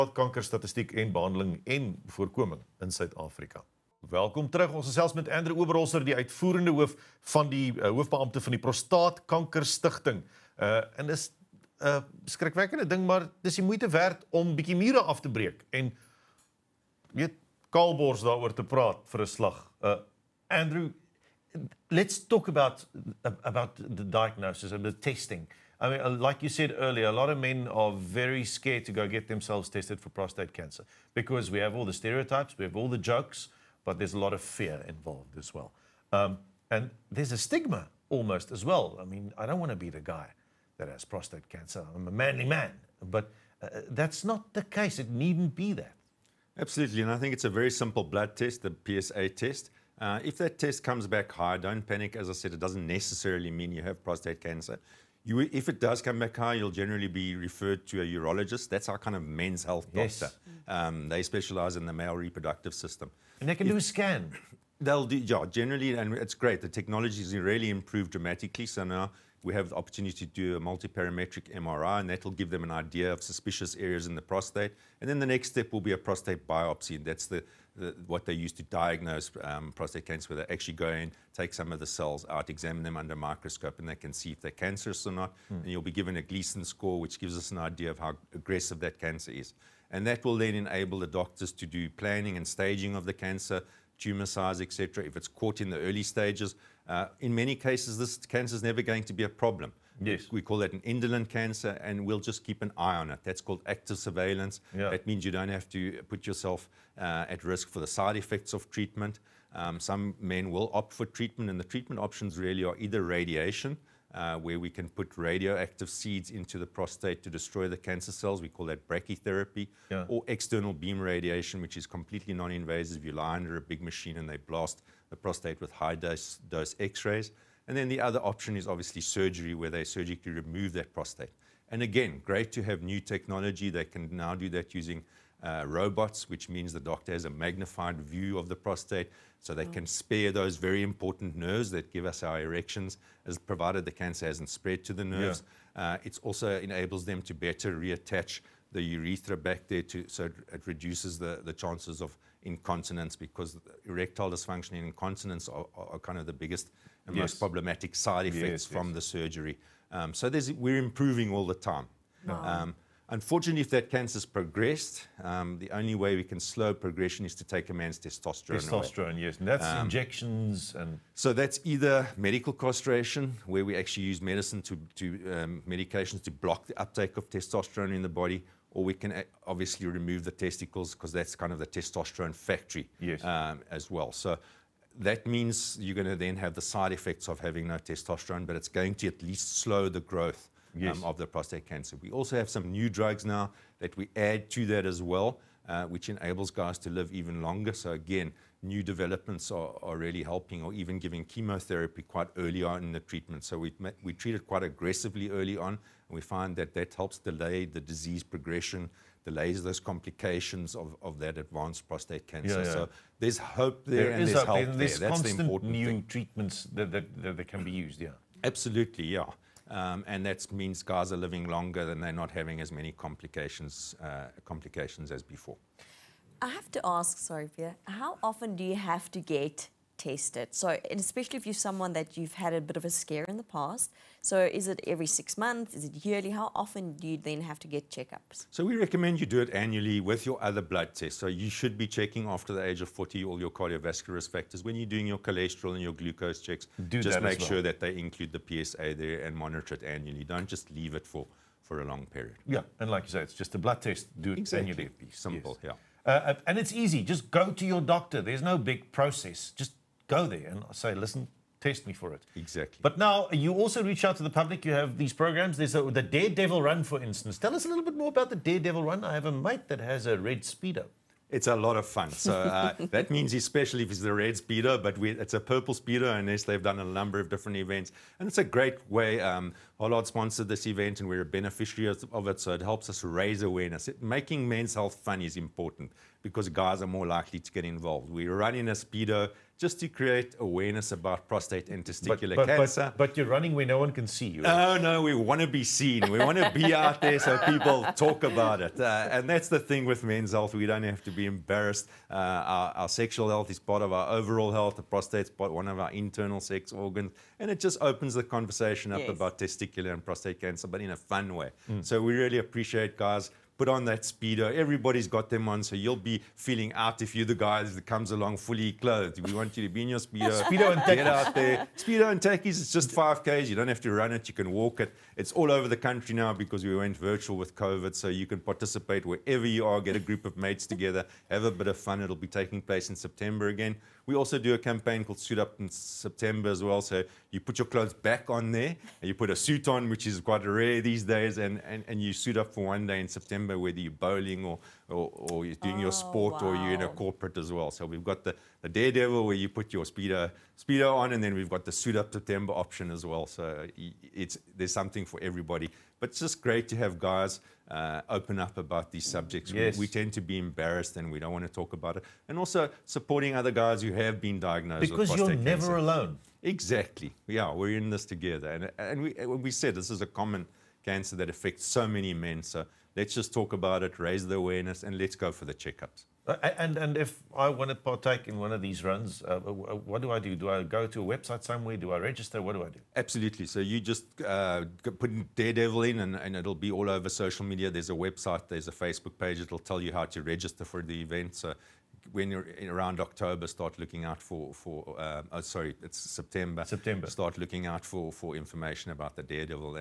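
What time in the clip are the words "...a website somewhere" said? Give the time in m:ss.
6:21.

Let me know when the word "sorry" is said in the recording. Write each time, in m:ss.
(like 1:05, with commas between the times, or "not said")
3:47, 6:35.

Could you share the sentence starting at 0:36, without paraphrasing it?
Um, and there's a stigma almost as well.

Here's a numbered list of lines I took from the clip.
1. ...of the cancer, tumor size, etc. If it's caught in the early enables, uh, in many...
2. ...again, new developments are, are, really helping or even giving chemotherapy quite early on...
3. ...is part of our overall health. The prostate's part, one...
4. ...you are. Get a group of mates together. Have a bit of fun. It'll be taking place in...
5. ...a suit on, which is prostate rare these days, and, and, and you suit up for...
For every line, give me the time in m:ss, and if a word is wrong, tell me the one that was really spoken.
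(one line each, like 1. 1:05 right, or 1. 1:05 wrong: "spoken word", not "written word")
1. 1:32 wrong: "stages", not "enables"
2. 3:17 right
3. 5:03 right
4. 5:29 right
5. 5:39 wrong: "quite", not "prostate".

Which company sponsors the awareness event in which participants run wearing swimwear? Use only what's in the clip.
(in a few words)
Hollard.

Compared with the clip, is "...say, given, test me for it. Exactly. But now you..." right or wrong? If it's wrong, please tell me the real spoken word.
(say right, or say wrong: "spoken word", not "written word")
wrong: "listen", not "given".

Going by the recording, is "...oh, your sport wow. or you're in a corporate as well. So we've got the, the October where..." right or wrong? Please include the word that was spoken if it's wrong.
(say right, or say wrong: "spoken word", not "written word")
wrong: "Daredevil", not "October".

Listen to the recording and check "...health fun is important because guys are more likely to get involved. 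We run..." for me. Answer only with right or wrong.
right.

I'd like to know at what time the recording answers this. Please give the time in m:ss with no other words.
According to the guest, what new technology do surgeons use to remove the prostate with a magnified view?
2:15.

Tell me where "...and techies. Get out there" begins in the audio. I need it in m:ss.
5:20.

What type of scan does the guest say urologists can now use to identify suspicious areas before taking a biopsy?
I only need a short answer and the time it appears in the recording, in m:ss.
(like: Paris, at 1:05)
Multiparametric MRI, at 1:10.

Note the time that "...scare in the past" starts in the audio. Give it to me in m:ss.
3:52.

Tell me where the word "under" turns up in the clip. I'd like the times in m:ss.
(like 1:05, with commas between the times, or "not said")
1:22, 2:03.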